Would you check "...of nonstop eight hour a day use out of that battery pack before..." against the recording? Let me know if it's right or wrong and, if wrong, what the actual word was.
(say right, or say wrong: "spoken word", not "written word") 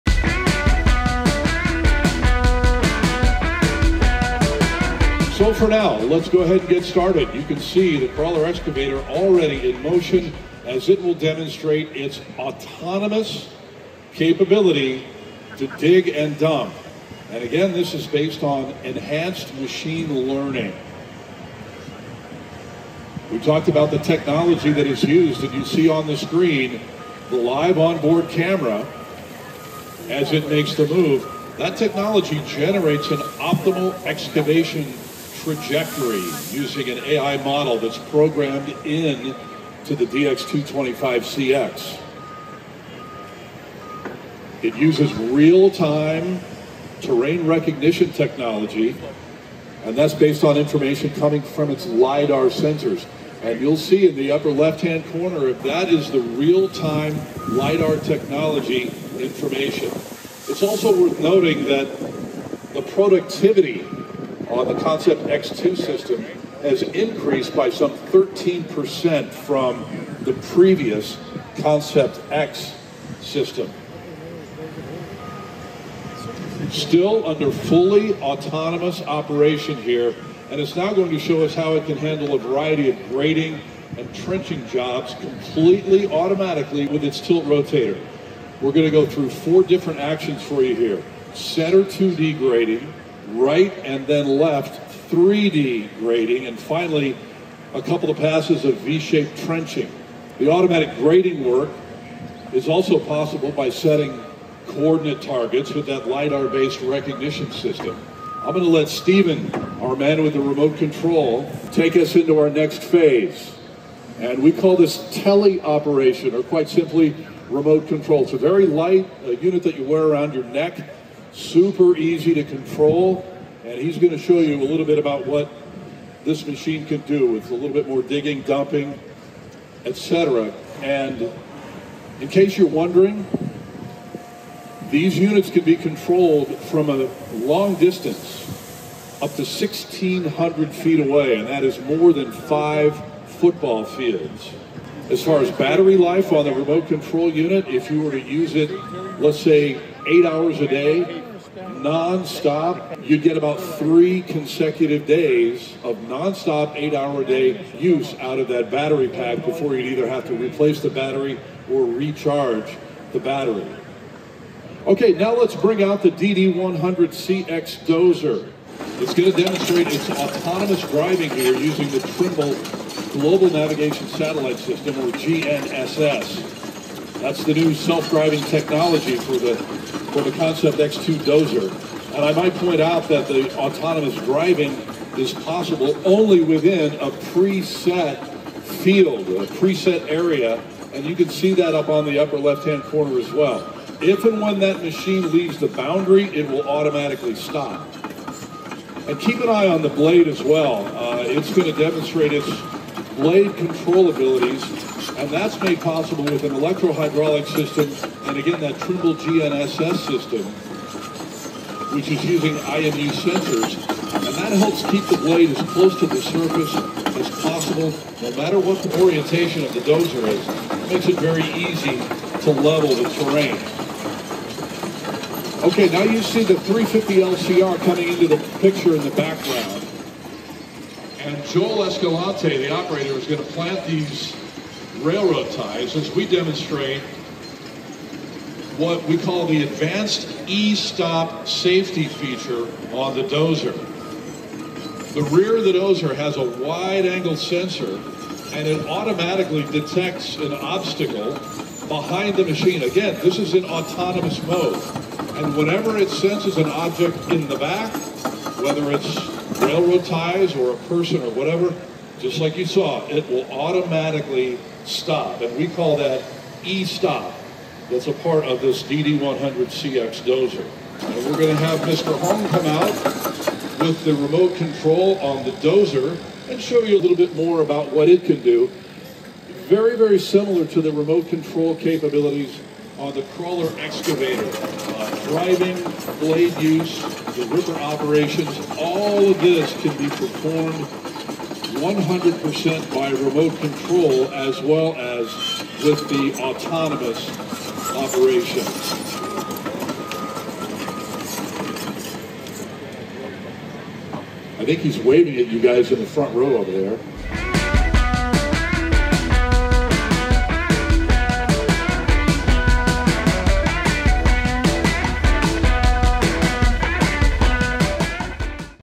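right.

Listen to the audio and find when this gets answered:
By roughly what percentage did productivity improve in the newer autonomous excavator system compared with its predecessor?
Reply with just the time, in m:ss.
1:07.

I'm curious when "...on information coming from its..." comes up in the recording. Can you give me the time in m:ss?
0:50.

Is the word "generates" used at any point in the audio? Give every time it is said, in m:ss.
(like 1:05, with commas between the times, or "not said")
0:32.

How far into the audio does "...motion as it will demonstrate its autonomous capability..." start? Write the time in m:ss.
0:09.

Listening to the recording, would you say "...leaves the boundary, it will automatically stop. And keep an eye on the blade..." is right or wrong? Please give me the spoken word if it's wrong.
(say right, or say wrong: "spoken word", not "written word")
right.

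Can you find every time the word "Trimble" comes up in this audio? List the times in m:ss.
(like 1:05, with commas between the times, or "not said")
2:52, 3:28.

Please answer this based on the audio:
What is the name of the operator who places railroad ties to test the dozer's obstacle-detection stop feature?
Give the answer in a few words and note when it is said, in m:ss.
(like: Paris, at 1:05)
Joel Escalante, at 3:51.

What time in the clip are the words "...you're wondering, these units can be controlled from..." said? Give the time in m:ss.
2:12.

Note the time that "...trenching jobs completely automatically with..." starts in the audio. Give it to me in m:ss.
1:24.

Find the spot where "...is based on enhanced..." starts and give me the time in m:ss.
0:17.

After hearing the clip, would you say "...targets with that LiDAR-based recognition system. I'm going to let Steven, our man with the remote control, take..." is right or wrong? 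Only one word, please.
right.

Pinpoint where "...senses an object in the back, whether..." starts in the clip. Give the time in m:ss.
4:16.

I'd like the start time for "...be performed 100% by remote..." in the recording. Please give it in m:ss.
4:49.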